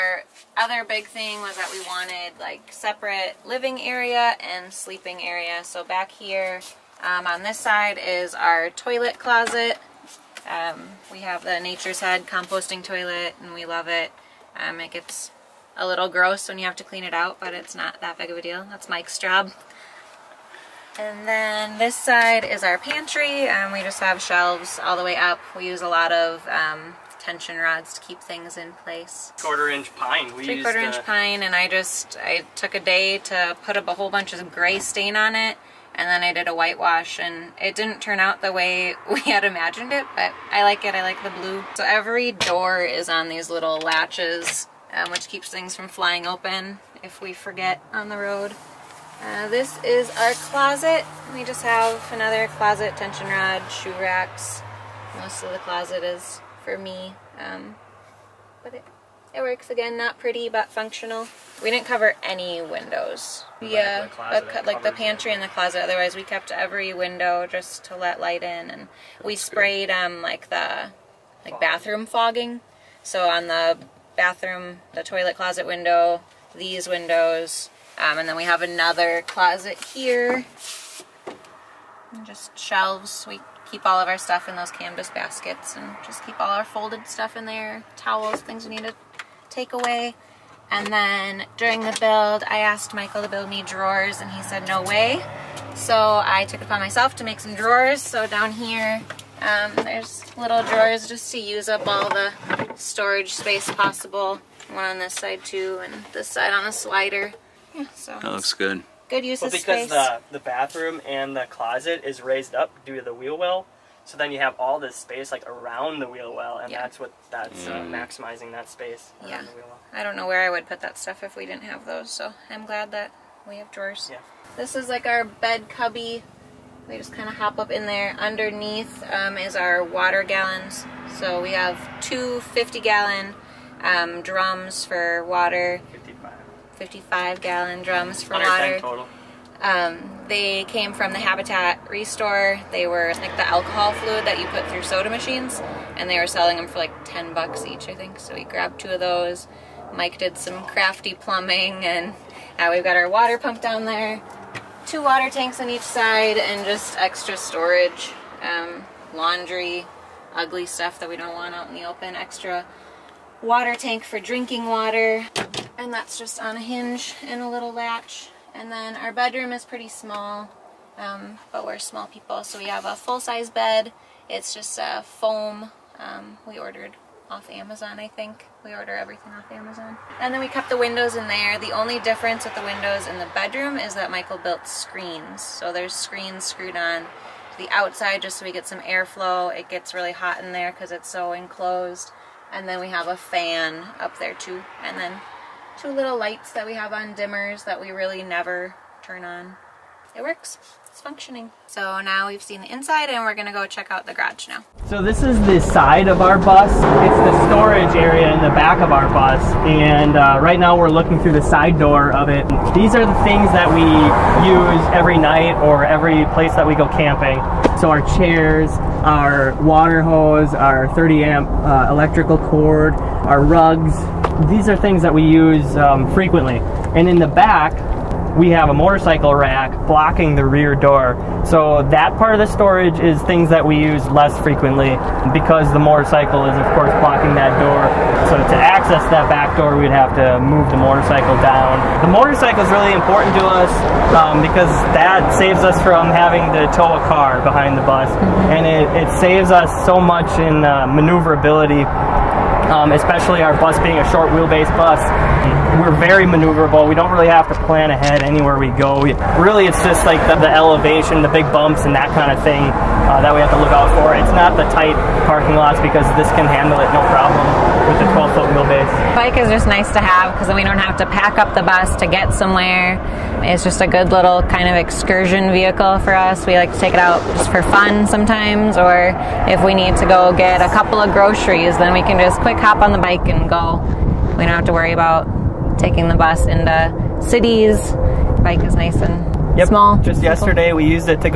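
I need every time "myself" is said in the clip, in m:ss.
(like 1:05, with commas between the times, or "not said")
1:36.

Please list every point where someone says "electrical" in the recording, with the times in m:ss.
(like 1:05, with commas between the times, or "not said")
3:41.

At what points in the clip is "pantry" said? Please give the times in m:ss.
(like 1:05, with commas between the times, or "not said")
0:22, 1:04.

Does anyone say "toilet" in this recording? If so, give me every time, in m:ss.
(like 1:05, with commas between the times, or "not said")
0:08, 0:12, 1:15.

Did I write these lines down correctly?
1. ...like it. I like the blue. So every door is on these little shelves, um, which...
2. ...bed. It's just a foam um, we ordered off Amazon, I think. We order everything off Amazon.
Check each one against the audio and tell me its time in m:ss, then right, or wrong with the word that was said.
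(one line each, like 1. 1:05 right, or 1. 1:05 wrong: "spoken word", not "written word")
1. 0:40 wrong: "latches", not "shelves"
2. 2:53 right.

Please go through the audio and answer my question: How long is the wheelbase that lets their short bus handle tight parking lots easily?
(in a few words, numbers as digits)
12 feet.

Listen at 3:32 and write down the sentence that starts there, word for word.
These are the things that we use every night or every place that we go camping.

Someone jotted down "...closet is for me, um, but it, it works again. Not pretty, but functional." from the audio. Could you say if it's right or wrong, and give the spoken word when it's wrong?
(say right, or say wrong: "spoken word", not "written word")
right.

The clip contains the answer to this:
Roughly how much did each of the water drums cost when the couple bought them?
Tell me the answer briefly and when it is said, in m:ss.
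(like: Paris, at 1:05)
$10, at 2:27.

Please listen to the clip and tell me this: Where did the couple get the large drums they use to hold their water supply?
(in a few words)
Habitat Restore.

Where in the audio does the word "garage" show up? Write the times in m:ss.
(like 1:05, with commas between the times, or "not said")
3:24.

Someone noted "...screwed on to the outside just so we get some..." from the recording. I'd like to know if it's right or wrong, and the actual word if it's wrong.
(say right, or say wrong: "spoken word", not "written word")
right.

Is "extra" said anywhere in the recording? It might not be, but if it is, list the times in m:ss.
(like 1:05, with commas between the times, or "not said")
2:36, 2:42.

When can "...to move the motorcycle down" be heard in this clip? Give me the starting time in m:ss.
4:00.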